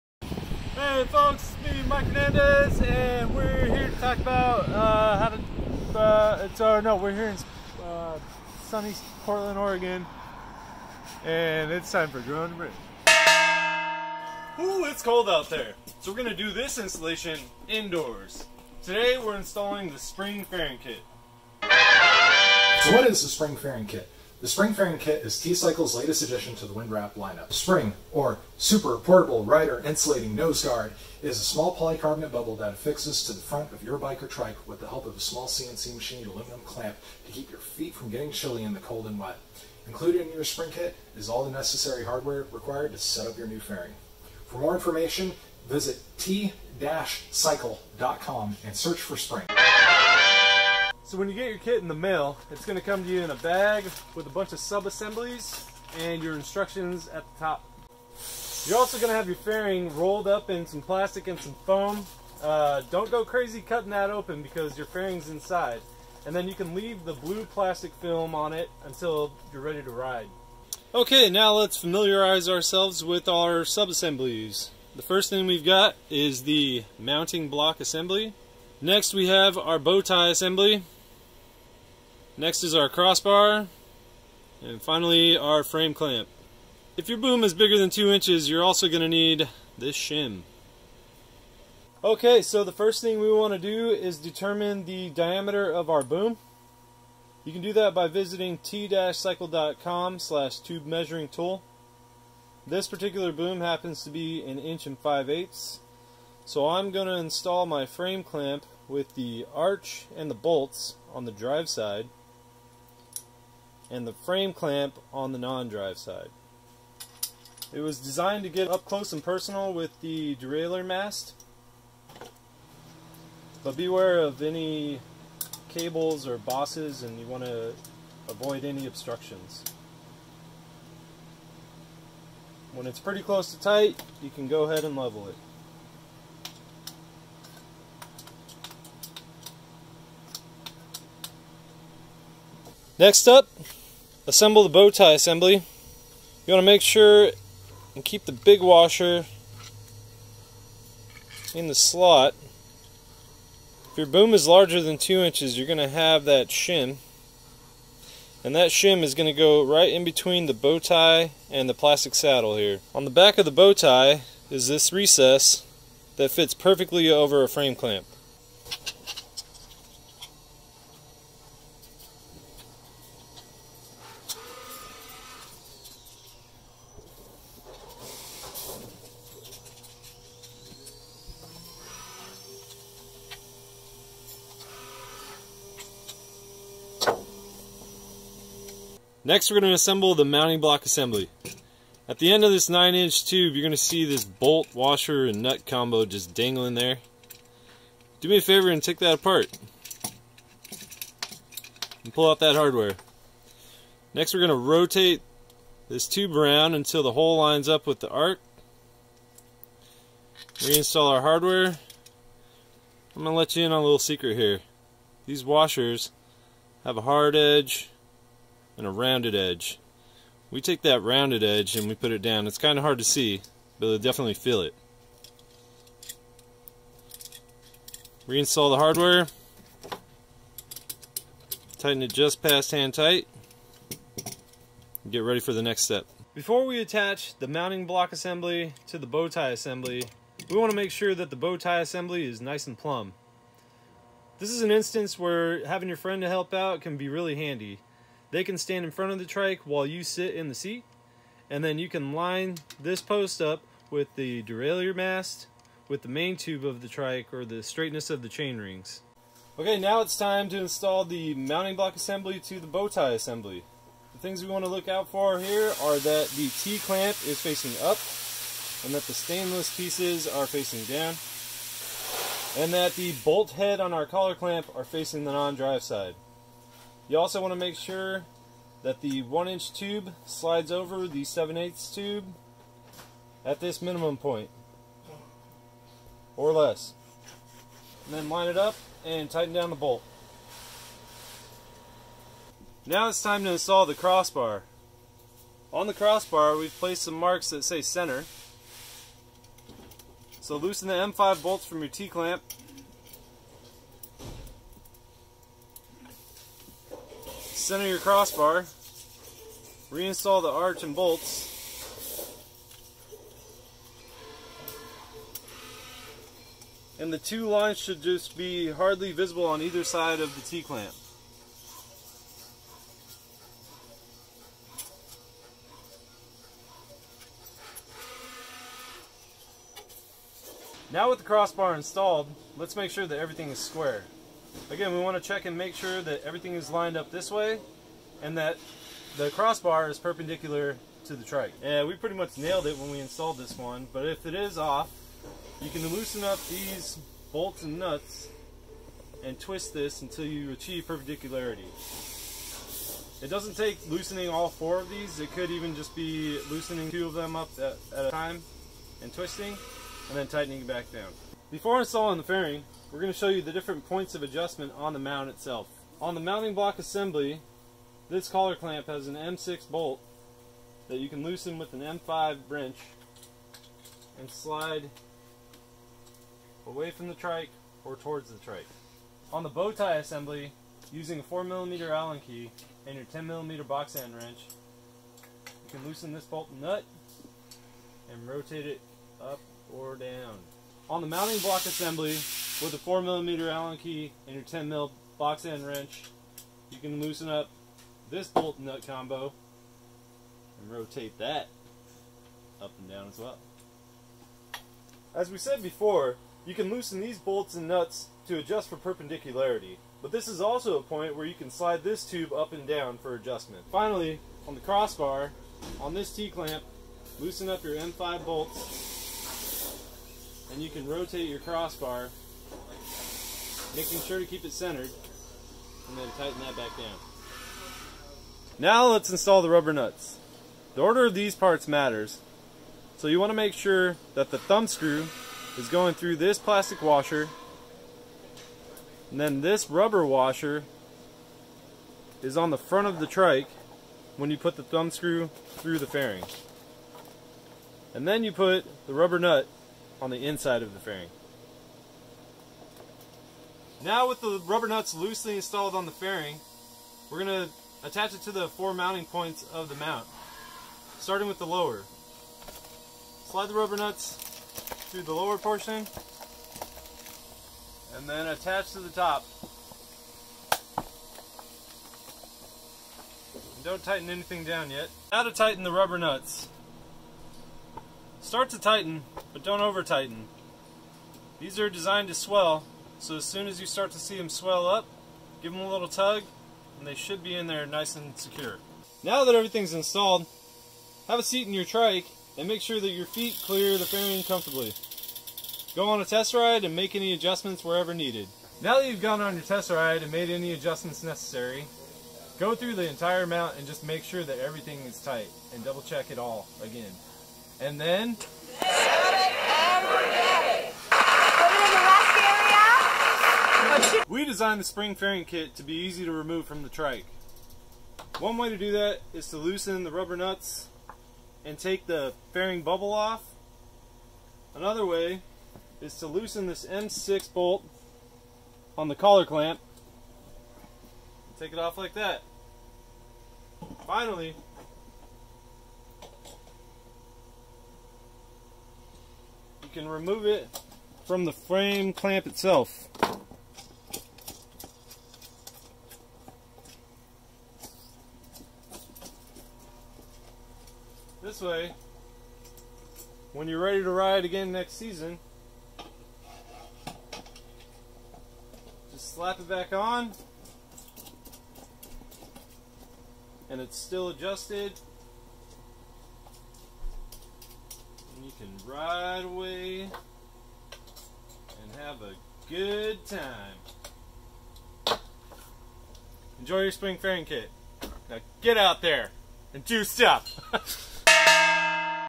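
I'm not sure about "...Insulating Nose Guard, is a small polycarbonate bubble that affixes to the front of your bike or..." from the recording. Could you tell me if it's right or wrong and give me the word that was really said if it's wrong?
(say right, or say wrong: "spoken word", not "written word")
right.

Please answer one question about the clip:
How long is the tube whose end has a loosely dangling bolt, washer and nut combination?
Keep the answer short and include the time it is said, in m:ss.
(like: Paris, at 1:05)
9 inches, at 3:12.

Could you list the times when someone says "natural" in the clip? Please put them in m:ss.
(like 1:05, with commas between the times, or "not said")
not said.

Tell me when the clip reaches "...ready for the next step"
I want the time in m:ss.
3:55.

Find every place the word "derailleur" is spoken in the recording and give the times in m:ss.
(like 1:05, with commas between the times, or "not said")
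2:00, 4:14.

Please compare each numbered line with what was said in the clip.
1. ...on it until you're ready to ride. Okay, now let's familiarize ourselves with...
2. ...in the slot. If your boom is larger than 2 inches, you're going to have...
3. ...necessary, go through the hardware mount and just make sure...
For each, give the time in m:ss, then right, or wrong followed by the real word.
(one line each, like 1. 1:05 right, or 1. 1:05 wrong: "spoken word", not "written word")
1. 1:08 right
2. 2:31 right
3. 8:21 wrong: "entire", not "hardware".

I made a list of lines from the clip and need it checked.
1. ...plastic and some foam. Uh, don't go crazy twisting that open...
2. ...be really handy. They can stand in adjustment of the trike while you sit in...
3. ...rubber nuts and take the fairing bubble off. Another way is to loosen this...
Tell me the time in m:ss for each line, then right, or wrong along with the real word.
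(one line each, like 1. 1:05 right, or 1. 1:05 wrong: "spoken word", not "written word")
1. 1:00 wrong: "cutting", not "twisting"
2. 4:06 wrong: "front", not "adjustment"
3. 8:39 right.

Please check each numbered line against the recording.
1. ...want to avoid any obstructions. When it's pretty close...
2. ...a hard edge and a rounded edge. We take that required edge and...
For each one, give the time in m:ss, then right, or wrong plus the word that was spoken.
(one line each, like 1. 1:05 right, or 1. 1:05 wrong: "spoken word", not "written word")
1. 2:07 right
2. 3:36 wrong: "rounded", not "required".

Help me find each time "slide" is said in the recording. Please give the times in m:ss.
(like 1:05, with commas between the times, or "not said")
4:40, 6:14, 6:51, 7:43.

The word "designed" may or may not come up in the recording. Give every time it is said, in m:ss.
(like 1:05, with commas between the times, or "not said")
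1:57, 8:01, 8:34.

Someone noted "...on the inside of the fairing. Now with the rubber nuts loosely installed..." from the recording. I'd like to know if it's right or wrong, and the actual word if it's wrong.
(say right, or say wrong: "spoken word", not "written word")
right.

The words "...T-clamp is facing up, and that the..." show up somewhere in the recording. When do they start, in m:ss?
4:26.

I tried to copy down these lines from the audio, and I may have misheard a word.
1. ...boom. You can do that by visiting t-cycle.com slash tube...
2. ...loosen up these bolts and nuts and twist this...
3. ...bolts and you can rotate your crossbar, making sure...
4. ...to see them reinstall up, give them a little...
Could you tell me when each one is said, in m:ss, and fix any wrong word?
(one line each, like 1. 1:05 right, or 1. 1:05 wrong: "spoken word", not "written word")
1. 1:36 right
2. 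5:45 right
3. 6:58 right
4. 8:03 wrong: "swell", not "reinstall".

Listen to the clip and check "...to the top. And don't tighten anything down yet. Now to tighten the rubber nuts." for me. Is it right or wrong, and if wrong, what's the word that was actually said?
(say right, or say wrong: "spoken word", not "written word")
right.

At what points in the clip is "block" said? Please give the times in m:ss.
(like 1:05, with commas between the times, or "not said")
1:17, 3:10, 3:57, 4:21, 6:06, 6:31.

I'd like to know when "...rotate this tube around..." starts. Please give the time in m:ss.
3:24.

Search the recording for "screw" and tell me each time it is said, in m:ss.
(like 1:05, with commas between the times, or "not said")
7:14, 7:24.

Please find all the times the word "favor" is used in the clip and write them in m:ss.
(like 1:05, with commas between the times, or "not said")
3:18.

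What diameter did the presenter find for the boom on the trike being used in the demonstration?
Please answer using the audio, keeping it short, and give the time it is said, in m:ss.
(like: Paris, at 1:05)
1 5/8 inches, at 1:44.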